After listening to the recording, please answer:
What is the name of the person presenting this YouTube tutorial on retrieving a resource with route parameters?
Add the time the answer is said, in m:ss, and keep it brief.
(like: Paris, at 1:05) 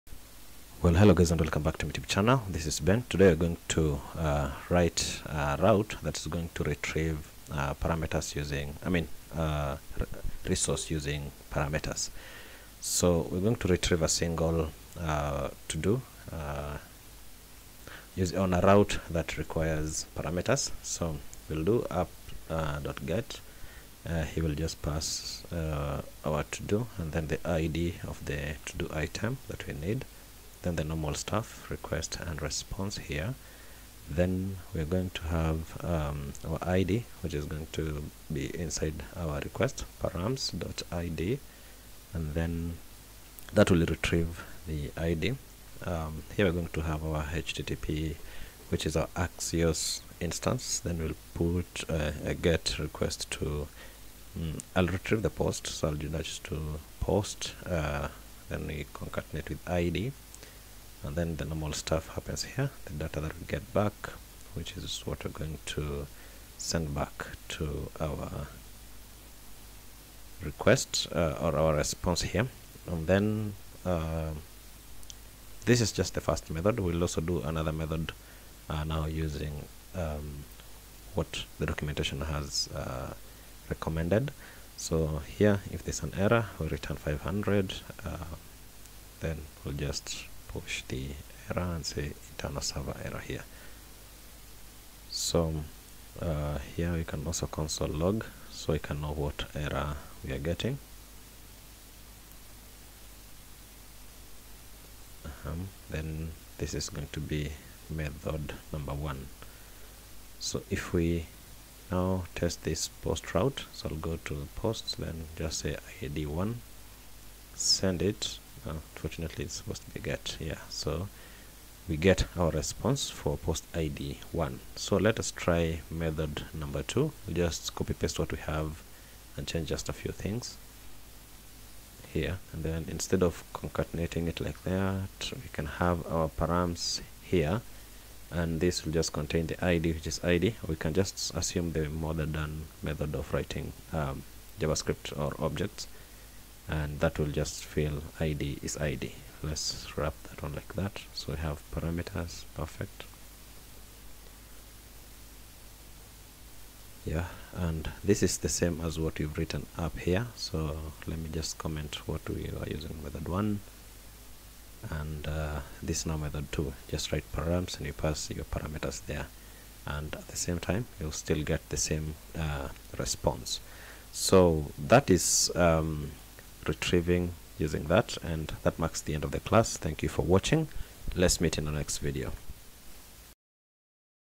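Ben, at 0:02.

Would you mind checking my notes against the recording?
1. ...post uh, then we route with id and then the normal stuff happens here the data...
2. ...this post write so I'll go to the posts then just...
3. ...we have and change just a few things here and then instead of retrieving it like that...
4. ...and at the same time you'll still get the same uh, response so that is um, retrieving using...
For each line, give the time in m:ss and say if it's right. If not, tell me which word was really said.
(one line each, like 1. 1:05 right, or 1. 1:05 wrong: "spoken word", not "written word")
1. 0:56 wrong: "concatenate", not "route"
2. 1:52 wrong: "route", not "write"
3. 2:08 wrong: "concatenating", not "retrieving"
4. 2:49 right.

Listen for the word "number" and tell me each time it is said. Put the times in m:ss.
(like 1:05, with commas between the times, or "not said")
1:48, 2:06.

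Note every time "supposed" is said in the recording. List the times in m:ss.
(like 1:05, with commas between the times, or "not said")
1:59.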